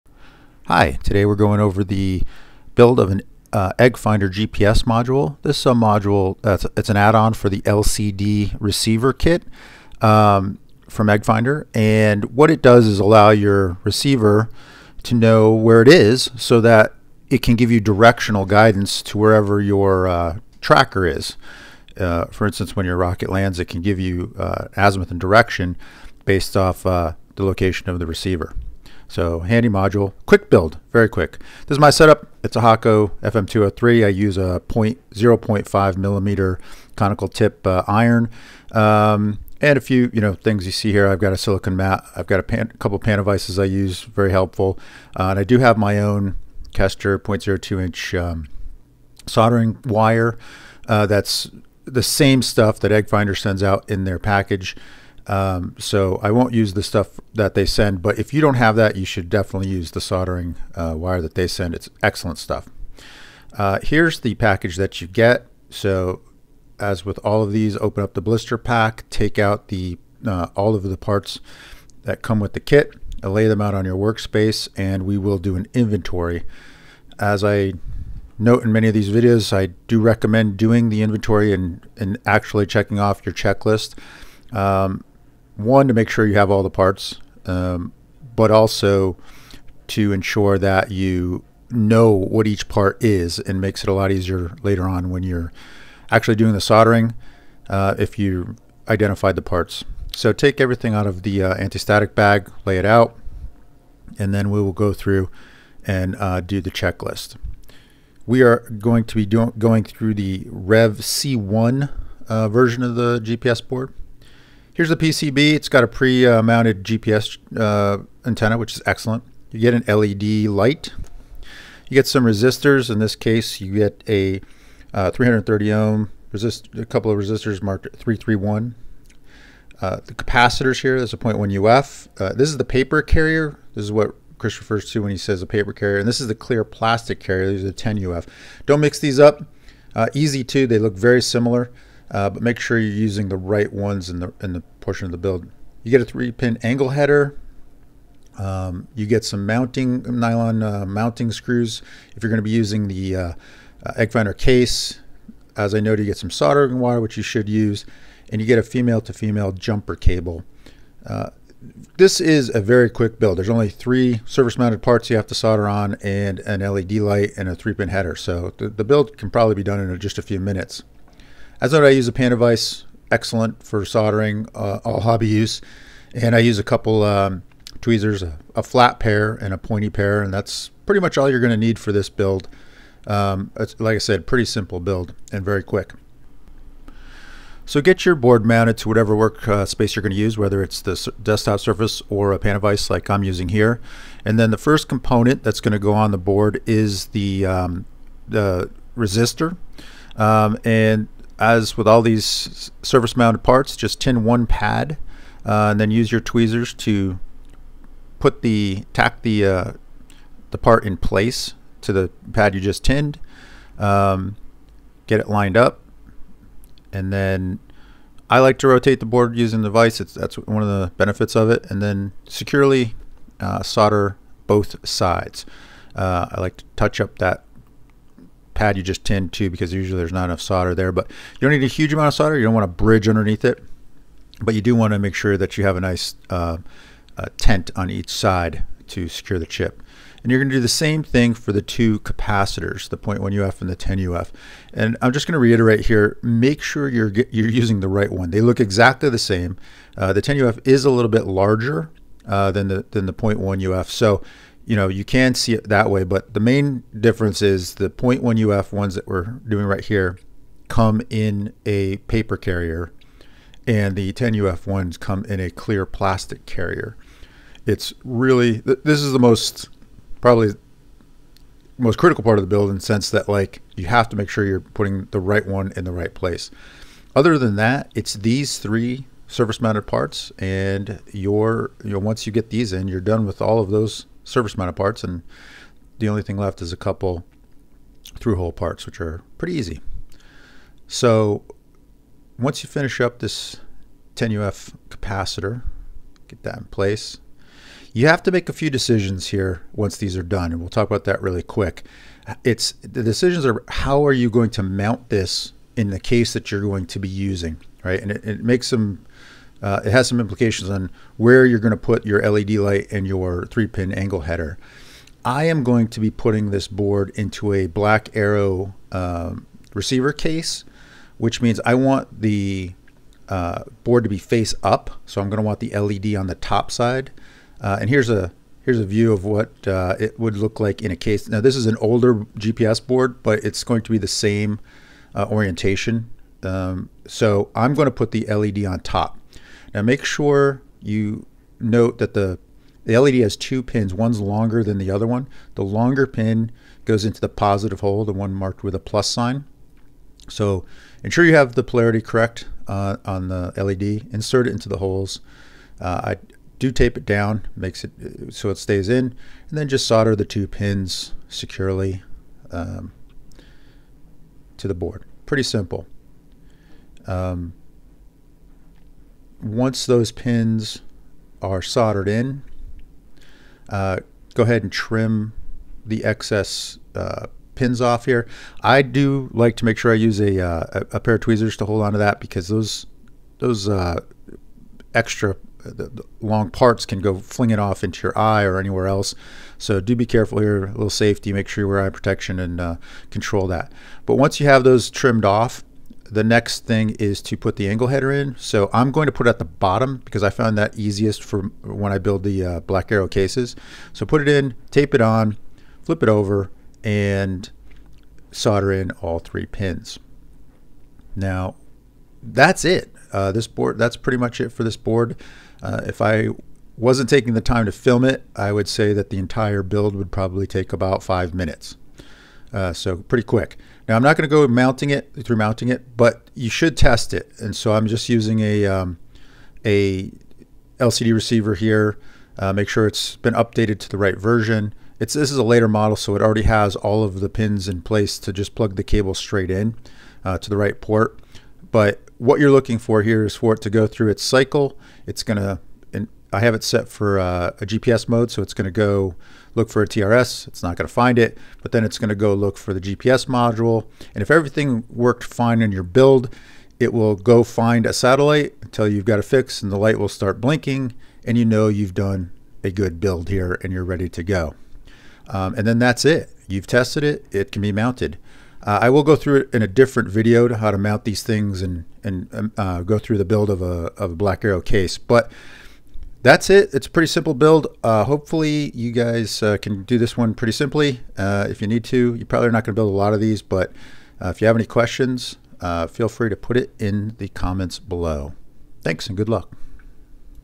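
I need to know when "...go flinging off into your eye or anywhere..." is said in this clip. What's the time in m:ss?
6:26.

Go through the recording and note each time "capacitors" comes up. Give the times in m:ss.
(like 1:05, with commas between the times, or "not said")
2:10, 4:02, 4:54.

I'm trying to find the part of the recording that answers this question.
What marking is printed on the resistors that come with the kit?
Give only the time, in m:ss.
2:07.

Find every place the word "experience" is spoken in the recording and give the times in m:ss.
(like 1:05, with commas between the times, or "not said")
not said.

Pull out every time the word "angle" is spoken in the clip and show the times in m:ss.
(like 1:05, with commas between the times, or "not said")
2:26, 5:13, 6:37.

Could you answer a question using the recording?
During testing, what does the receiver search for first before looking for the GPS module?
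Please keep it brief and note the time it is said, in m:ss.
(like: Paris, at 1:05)
TRS, at 7:29.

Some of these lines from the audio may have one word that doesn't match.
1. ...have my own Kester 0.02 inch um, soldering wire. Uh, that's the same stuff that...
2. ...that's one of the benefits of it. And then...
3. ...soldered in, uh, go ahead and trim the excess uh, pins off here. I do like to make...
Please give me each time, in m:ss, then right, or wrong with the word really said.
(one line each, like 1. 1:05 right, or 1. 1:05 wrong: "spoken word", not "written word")
1. 0:45 right
2. 3:40 right
3. 6:11 right.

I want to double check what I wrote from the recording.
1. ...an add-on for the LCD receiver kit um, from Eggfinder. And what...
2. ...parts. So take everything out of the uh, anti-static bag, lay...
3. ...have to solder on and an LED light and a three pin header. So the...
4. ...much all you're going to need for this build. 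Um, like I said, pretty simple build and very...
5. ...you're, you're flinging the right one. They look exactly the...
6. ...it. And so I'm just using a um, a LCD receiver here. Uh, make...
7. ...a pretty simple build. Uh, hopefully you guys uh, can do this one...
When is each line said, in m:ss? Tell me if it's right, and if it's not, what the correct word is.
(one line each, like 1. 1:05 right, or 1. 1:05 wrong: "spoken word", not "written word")
1. 0:06 right
2. 1:39 right
3. 2:45 right
4. 3:01 right
5. 4:06 wrong: "using", not "flinging"
6. 7:07 right
7. 7:56 right.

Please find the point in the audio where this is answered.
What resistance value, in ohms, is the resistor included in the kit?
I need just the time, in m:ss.
2:05.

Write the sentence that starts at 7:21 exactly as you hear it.
But what you're looking for here is for it to go through its cycle.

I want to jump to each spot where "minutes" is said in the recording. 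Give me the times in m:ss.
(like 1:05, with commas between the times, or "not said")
2:50, 7:01.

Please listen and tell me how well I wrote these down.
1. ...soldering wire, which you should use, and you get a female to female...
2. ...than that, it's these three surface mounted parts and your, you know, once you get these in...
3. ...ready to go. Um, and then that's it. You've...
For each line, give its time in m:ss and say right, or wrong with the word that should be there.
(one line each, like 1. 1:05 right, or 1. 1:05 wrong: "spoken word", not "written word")
1. 2:36 right
2. 4:37 right
3. 7:43 right.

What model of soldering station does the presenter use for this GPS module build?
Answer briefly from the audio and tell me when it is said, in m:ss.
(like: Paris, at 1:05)
Hakko FM203, at 0:32.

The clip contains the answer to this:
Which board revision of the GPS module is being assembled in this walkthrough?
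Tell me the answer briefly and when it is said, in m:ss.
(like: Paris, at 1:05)
Rev C1, at 1:50.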